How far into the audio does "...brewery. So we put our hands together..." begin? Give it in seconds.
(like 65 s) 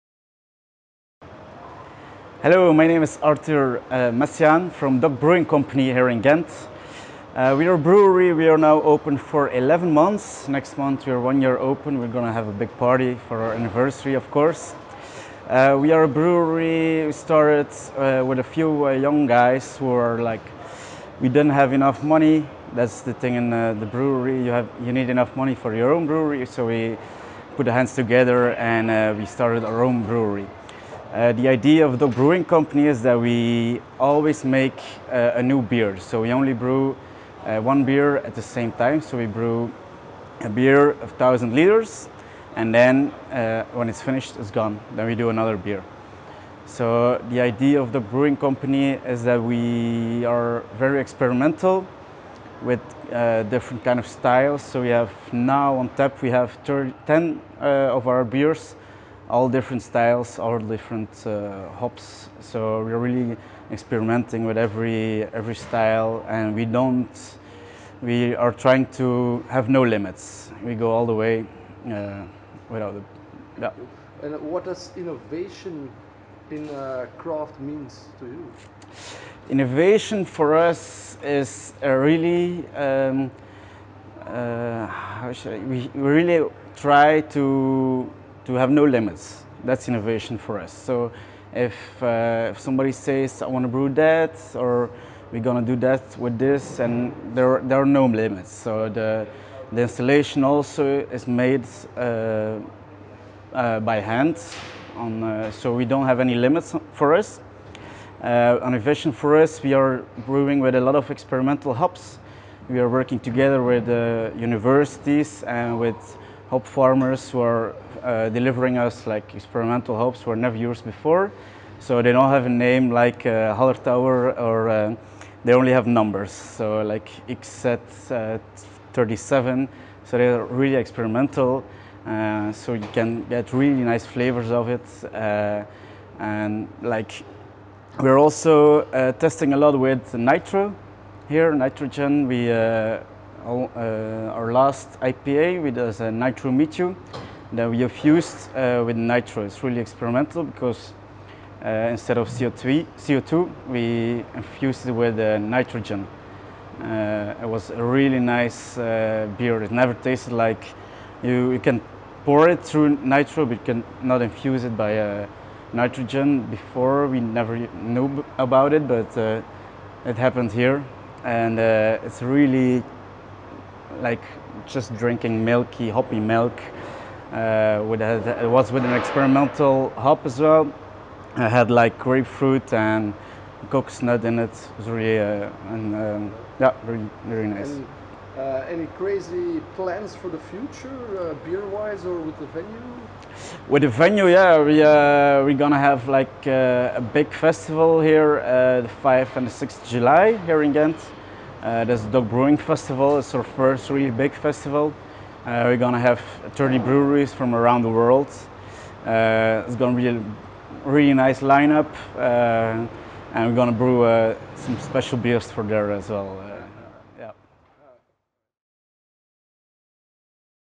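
26 s.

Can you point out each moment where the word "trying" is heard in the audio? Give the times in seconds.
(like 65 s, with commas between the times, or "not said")
68 s.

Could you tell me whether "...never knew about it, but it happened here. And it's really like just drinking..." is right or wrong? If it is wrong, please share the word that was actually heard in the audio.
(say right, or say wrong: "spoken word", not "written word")
right.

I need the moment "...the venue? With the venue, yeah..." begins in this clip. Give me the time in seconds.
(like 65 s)
192 s.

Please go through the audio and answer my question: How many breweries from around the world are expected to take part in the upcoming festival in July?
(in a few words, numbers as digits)
30.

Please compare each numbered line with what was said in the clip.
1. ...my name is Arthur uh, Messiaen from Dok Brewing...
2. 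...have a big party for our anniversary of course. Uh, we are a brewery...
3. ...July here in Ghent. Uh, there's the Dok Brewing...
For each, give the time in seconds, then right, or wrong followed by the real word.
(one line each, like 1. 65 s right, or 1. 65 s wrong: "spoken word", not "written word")
1. 2 s right
2. 12 s right
3. 199 s right.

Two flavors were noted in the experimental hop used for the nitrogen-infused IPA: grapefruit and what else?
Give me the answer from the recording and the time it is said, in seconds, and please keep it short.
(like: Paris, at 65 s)
Coconut, at 183 s.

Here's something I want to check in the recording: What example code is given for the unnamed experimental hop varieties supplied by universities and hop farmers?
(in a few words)
XZ37.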